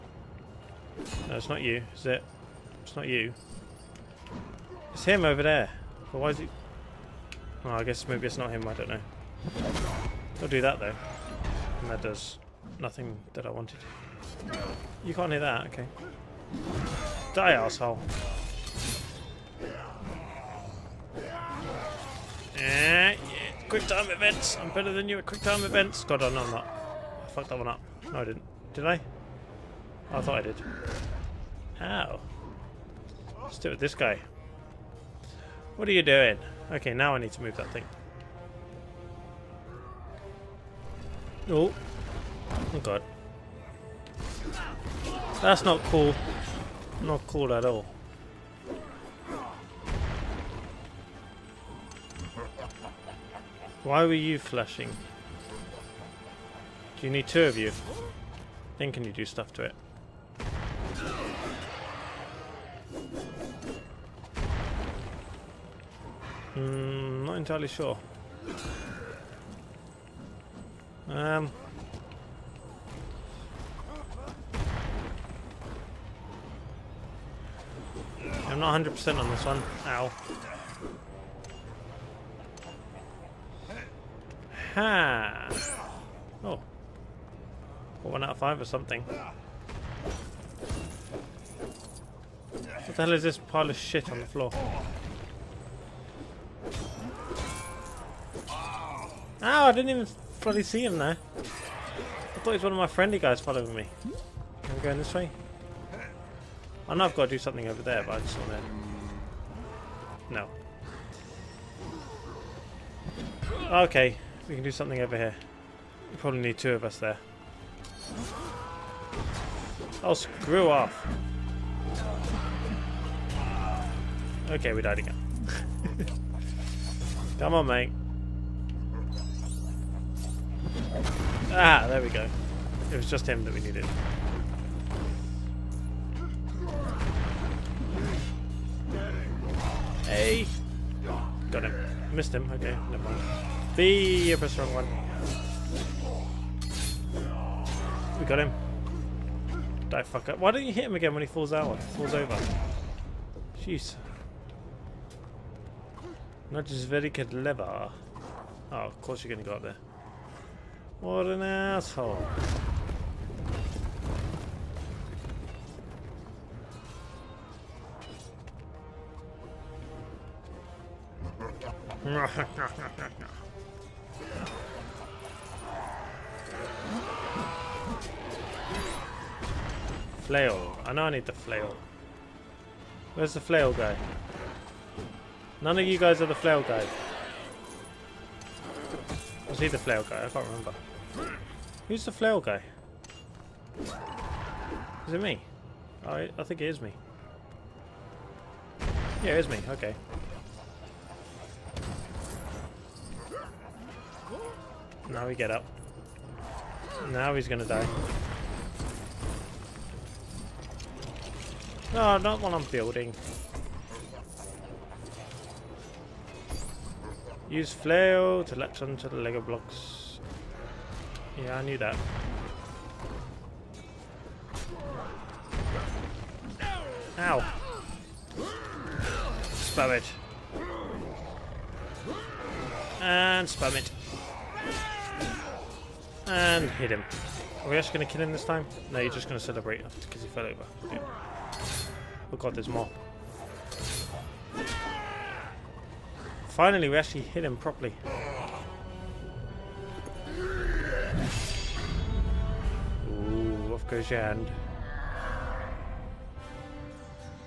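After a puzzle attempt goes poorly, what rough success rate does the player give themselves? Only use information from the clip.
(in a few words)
One out of five.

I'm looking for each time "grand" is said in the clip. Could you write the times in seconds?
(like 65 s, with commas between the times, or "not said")
not said.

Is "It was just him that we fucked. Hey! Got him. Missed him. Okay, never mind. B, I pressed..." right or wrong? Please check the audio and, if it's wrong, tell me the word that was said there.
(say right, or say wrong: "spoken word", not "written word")
wrong: "needed", not "fucked".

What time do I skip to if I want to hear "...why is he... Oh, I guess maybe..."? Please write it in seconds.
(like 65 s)
6 s.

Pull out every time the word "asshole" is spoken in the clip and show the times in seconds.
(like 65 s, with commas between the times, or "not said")
17 s, 161 s.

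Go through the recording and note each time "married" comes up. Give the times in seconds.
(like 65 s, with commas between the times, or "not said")
not said.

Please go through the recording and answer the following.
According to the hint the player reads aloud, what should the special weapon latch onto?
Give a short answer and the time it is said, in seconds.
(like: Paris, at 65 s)
Lego blocks, at 219 s.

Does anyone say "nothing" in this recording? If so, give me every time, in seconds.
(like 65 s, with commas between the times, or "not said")
12 s.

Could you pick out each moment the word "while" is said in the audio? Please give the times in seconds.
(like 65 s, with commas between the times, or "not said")
212 s.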